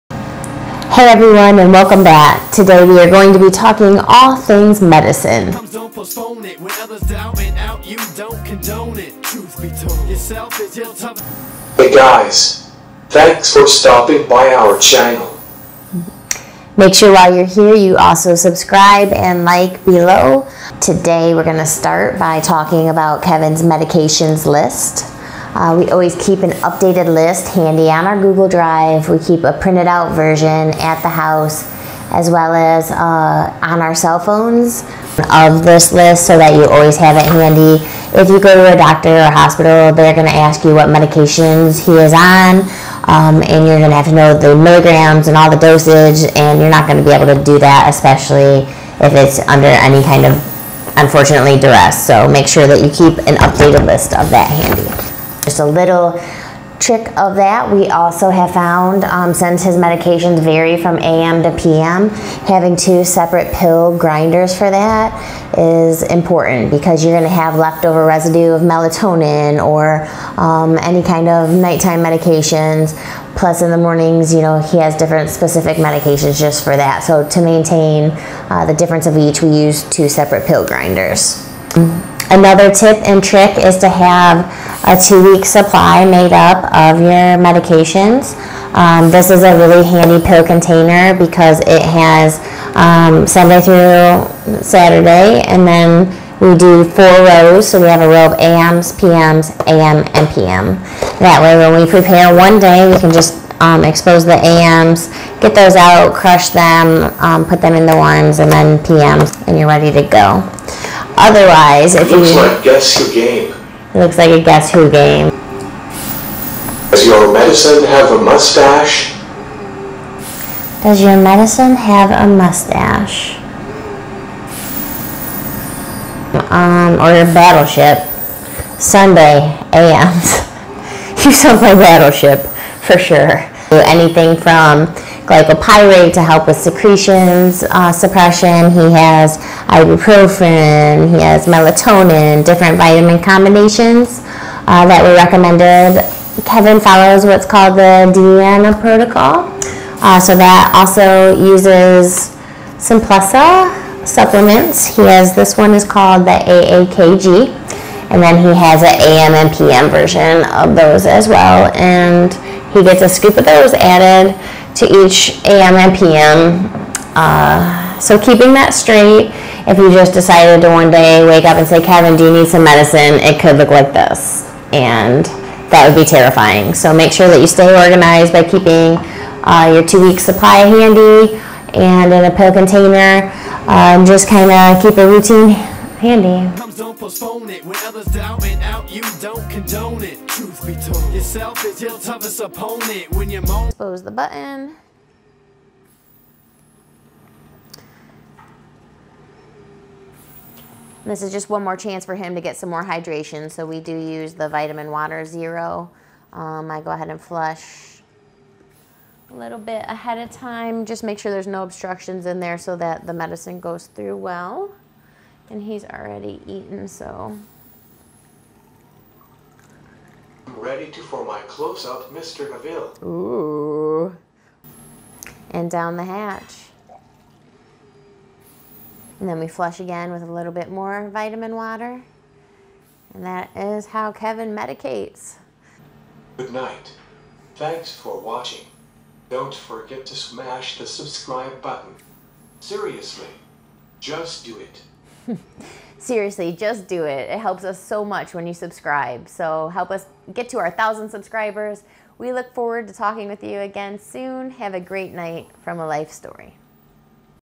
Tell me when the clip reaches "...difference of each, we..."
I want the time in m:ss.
1:18.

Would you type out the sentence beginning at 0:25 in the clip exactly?
Uh, we always keep an updated list handy on our Google Drive.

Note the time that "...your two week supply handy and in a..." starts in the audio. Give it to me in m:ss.
2:59.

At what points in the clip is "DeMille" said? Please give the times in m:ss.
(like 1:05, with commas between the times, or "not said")
3:42.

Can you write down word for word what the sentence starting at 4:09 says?
So help us get to our thousand subscribers.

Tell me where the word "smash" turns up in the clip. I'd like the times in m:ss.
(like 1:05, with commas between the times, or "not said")
4:00.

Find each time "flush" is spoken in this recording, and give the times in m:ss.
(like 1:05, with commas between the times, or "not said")
3:27, 3:49.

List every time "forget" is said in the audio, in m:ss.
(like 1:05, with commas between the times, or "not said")
3:59.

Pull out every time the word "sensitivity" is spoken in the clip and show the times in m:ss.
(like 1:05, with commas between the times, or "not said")
not said.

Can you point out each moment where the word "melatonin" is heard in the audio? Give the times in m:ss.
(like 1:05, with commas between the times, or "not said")
1:08, 2:21.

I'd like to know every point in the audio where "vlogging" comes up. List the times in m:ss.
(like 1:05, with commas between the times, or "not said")
not said.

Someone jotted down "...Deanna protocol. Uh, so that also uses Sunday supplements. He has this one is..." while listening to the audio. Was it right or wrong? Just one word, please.
wrong.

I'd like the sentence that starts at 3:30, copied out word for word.
Just make sure there's no obstructions in there so that the medicine goes through well.